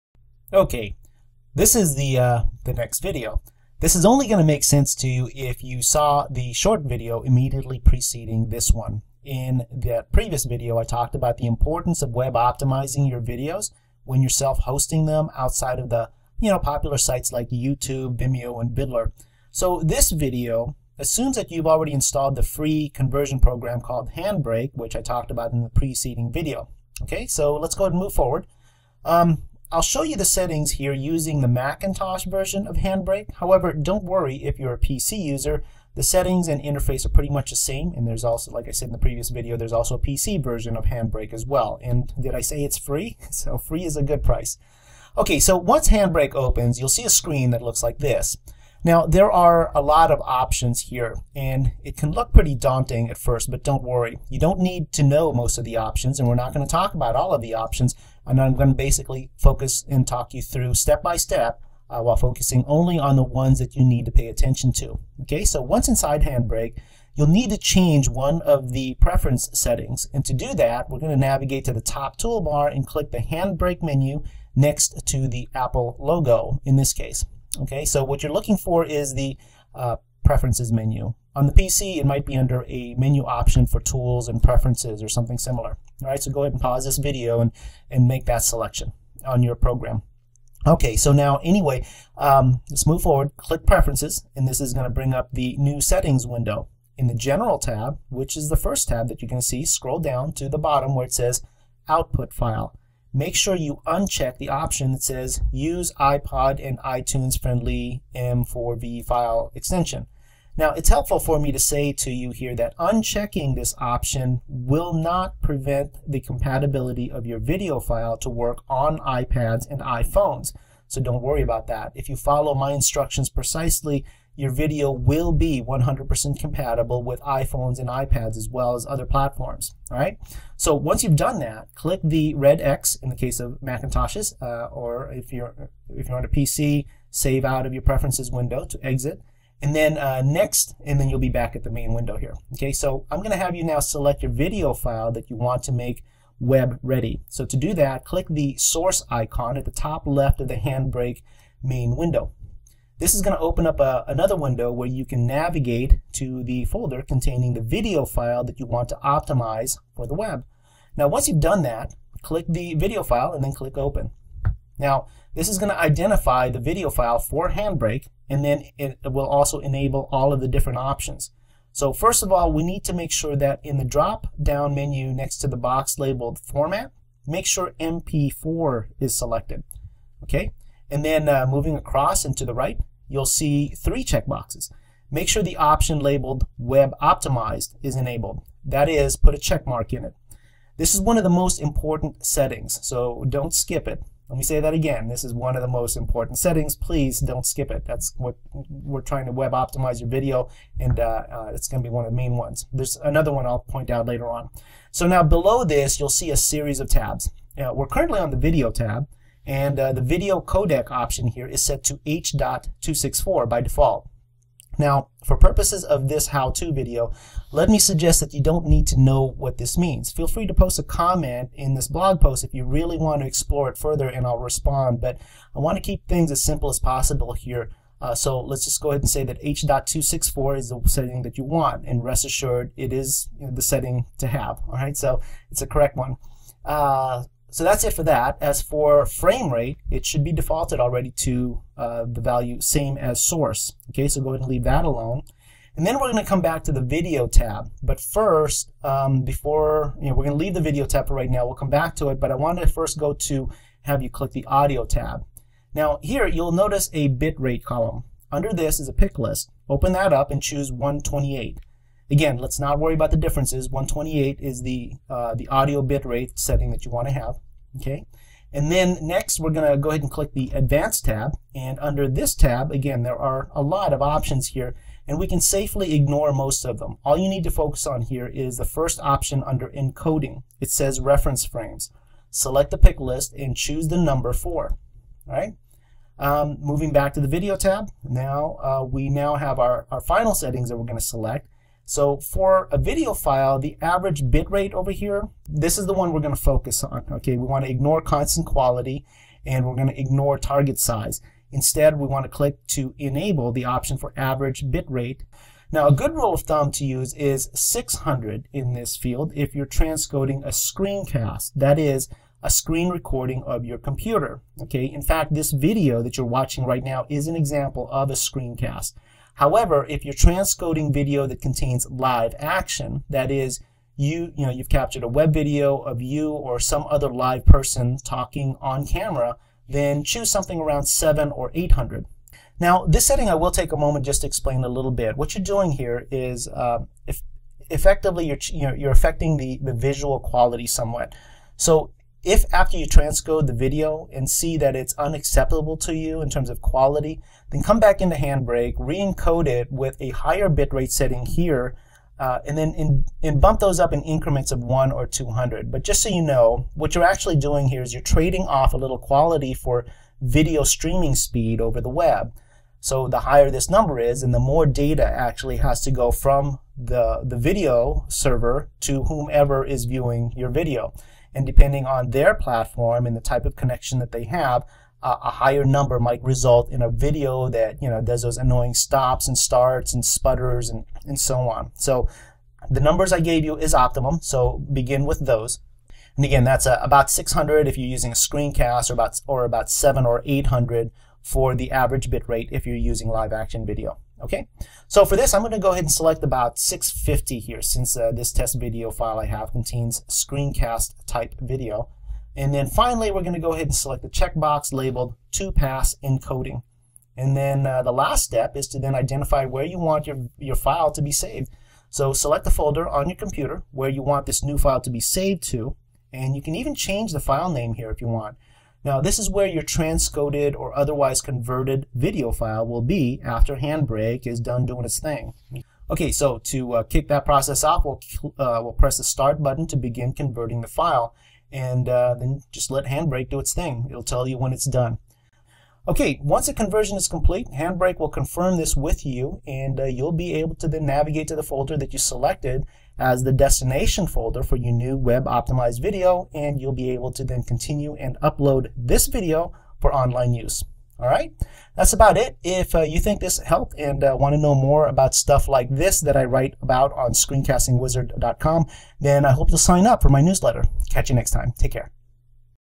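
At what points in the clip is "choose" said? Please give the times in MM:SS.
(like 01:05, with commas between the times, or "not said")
04:20, 04:43, 05:30.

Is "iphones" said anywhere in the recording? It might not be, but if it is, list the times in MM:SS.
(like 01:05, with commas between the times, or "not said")
01:59, 02:07.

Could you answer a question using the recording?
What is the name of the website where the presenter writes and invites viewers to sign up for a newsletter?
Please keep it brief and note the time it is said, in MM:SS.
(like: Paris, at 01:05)
screencastingwizard.com, at 07:37.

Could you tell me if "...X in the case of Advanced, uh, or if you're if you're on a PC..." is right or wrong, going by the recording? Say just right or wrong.
wrong.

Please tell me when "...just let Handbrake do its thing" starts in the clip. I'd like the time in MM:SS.
07:12.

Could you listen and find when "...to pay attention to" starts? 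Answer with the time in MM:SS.
01:04.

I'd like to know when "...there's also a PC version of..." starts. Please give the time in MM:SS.
00:39.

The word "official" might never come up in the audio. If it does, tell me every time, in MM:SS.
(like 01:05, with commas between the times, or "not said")
not said.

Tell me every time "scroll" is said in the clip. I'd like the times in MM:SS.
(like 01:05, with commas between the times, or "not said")
01:39.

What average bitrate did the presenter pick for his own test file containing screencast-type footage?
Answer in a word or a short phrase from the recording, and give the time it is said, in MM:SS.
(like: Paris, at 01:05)
650, at 06:36.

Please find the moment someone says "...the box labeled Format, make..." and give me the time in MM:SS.
02:55.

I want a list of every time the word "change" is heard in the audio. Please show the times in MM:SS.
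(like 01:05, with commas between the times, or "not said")
01:07, 06:56.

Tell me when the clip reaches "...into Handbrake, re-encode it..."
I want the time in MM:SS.
05:47.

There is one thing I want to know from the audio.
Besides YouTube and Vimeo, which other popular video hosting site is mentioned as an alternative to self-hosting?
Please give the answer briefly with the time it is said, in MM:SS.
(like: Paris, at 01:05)
Viddler, at 00:18.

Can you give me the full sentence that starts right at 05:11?
That is, a screen recording of your computer.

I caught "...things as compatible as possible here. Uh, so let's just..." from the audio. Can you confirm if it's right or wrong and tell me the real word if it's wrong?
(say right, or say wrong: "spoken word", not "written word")
wrong: "simple", not "compatible".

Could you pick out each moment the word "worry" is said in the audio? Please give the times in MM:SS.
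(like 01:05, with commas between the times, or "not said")
00:34, 00:53, 02:01, 04:22.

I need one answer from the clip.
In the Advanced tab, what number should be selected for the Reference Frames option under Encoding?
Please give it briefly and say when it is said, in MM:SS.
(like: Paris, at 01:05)
4, at 04:44.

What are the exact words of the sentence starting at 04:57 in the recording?
Okay, we want to ignore constant quality and we're going to ignore target size.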